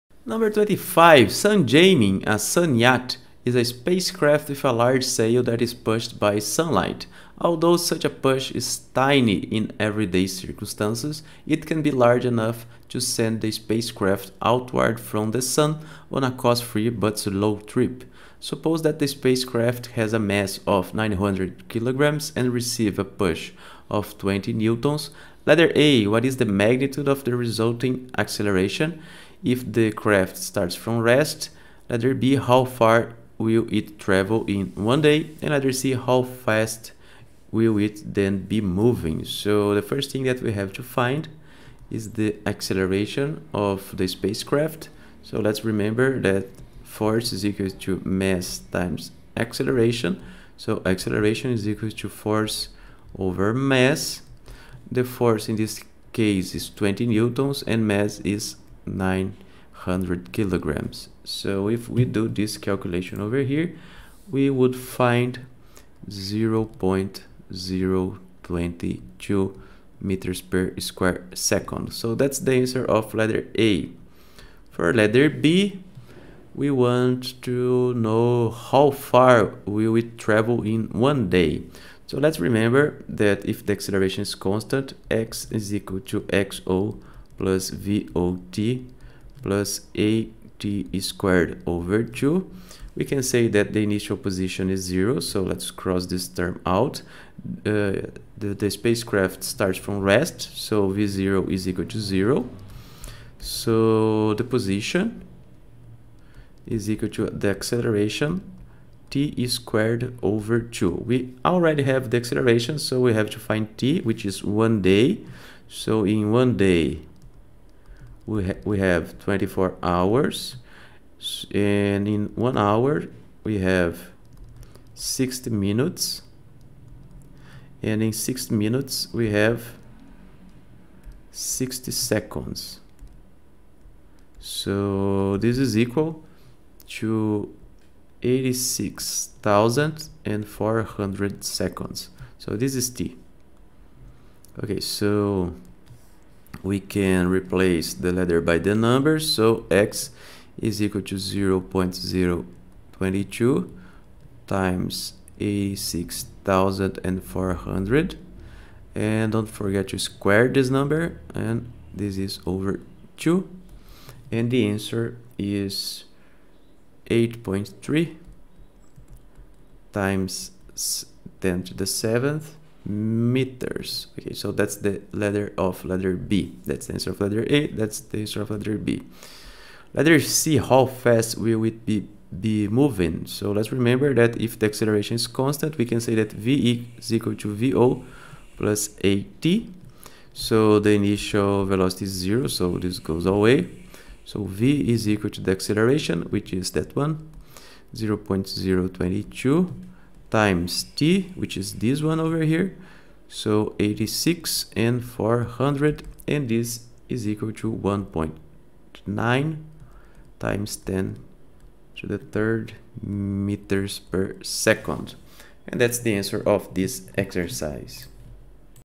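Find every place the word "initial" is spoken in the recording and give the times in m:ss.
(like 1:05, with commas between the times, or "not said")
1:33, 3:10.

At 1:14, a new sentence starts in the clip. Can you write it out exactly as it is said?
For letter B, we want to know how far will it travel in one day.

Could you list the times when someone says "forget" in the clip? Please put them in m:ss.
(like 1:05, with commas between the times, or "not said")
2:39.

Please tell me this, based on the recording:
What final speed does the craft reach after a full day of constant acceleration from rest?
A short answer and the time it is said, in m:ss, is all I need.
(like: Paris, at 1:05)
1.9 x 10^3 meters per second, at 3:27.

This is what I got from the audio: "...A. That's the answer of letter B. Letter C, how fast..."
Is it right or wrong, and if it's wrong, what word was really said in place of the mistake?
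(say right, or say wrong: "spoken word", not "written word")
right.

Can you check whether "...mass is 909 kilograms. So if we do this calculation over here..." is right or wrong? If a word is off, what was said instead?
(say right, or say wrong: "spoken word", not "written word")
wrong: "900", not "909".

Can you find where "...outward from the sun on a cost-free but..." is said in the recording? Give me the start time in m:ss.
0:14.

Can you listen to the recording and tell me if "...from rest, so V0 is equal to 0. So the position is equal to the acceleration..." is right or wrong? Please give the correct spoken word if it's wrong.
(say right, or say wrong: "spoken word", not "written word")
right.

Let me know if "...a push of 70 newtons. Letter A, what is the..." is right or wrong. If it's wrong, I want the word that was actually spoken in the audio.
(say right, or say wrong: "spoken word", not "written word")
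wrong: "20", not "70".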